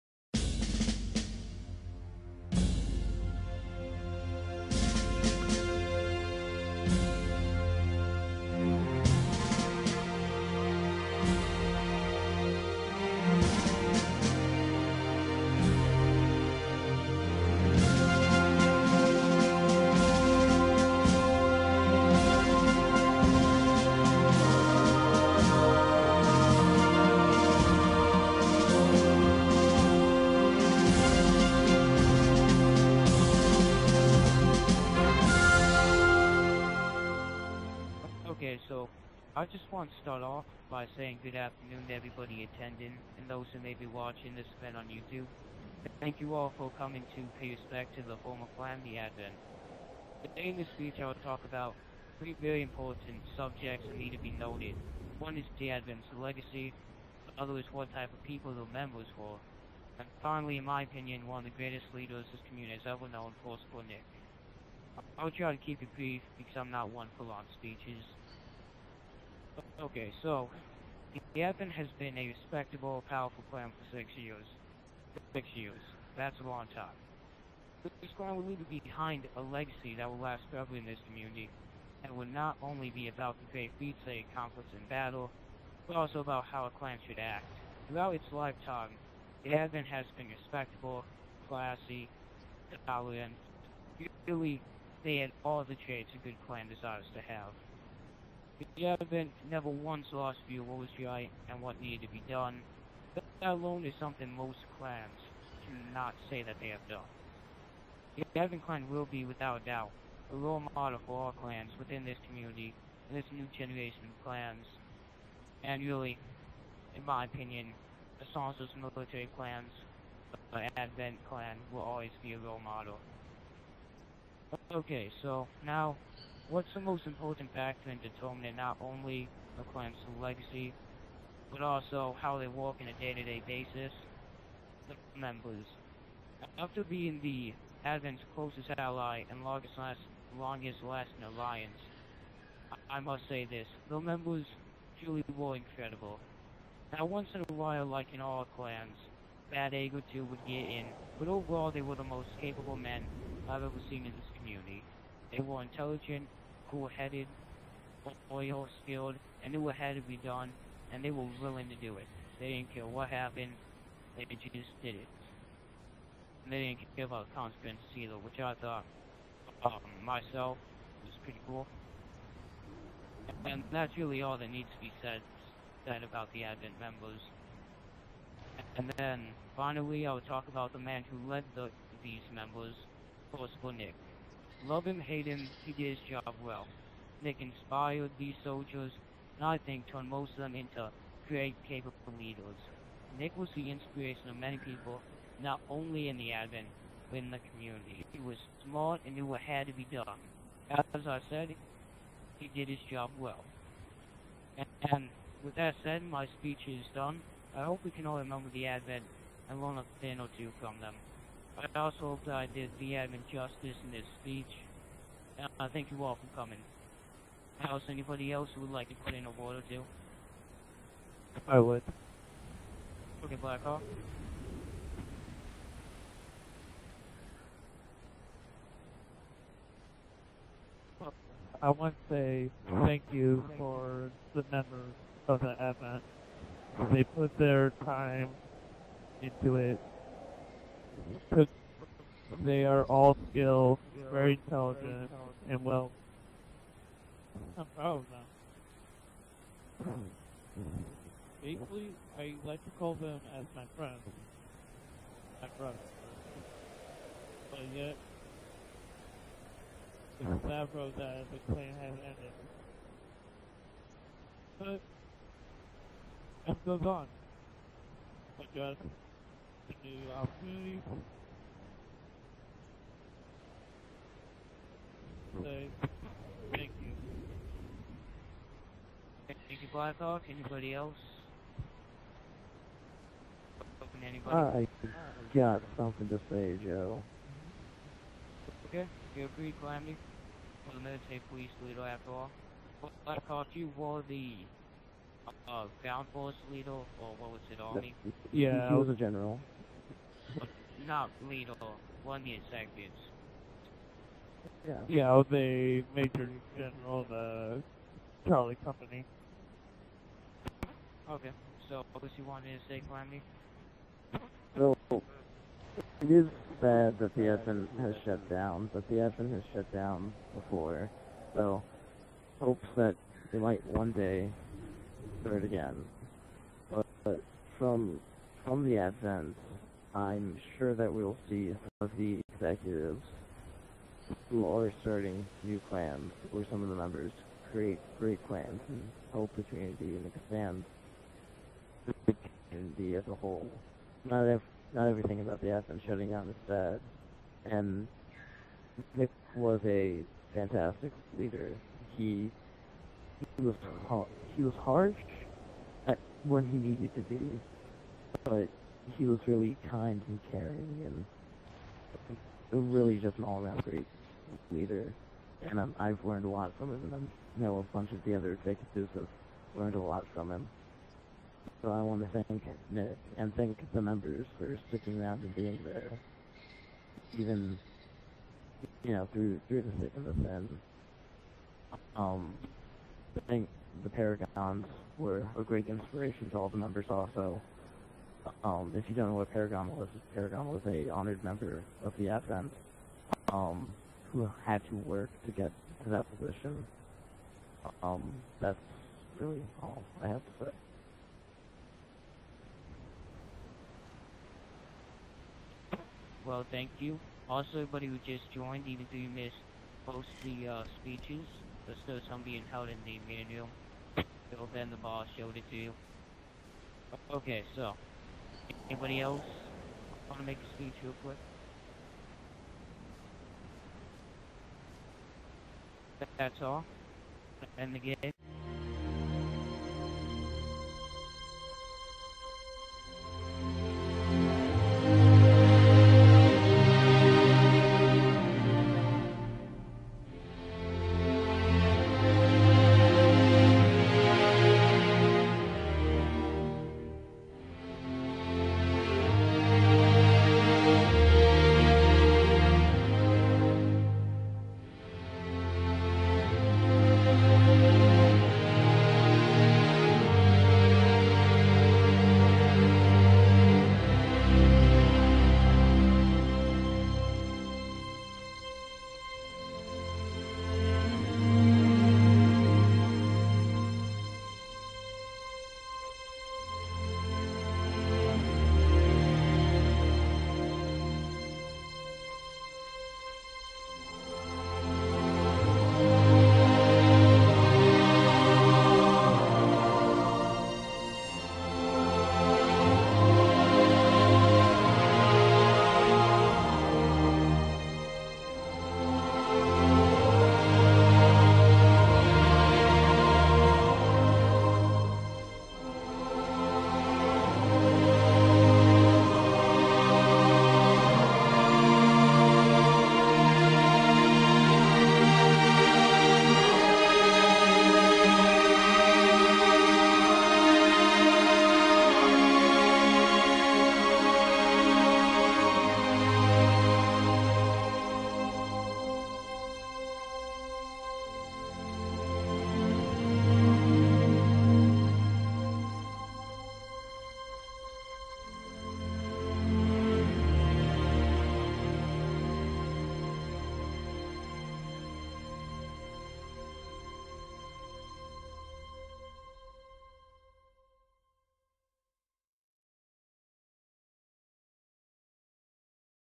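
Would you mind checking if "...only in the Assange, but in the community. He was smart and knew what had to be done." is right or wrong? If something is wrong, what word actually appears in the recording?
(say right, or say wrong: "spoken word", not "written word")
wrong: "Advent", not "Assange".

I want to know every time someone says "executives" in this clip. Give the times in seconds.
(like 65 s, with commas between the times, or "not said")
332 s, 368 s.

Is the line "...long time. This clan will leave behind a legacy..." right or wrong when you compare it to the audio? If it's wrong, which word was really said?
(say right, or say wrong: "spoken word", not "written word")
right.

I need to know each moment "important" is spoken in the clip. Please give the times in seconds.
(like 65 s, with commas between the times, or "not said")
52 s, 127 s.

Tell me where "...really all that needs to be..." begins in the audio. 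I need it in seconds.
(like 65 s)
173 s.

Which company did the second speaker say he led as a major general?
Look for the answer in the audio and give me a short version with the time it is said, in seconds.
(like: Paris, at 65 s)
Charlie company, at 308 s.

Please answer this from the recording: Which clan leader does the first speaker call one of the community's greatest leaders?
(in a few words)
Force Nick.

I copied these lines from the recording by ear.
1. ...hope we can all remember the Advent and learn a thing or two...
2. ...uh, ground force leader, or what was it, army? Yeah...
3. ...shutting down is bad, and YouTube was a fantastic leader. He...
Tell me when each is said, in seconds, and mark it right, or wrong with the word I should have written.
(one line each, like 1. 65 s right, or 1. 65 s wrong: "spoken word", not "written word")
1. 207 s right
2. 295 s right
3. 345 s wrong: "Nick", not "YouTube".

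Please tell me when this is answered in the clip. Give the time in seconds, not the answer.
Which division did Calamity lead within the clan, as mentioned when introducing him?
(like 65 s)
290 s.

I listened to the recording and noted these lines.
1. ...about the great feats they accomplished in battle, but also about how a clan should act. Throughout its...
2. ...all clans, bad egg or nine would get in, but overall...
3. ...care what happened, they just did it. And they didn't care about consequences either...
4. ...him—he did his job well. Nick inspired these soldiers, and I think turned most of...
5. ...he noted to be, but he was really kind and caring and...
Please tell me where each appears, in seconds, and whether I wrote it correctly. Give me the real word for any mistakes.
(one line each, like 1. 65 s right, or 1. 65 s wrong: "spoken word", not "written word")
1. 83 s right
2. 148 s wrong: "two", not "nine"
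3. 162 s right
4. 185 s right
5. 356 s wrong: "needed", not "noted".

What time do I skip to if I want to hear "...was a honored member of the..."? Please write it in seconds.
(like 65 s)
390 s.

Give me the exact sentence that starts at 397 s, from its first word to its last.
Um, that's really all I have to say.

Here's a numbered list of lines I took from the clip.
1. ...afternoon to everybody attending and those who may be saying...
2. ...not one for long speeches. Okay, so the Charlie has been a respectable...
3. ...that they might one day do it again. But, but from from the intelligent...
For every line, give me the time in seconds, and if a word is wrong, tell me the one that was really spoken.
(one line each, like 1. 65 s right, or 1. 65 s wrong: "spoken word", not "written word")
1. 41 s wrong: "watching", not "saying"
2. 66 s wrong: "Advent", not "Charlie"
3. 322 s wrong: "advent", not "intelligent".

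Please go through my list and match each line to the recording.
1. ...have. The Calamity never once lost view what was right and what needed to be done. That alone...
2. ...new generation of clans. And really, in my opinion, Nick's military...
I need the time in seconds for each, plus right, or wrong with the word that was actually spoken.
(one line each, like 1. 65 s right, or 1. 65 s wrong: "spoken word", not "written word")
1. 97 s wrong: "Advent", not "Calamity"
2. 113 s wrong: "Assange", not "Nick".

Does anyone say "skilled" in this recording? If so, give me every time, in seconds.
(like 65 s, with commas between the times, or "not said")
158 s, 243 s.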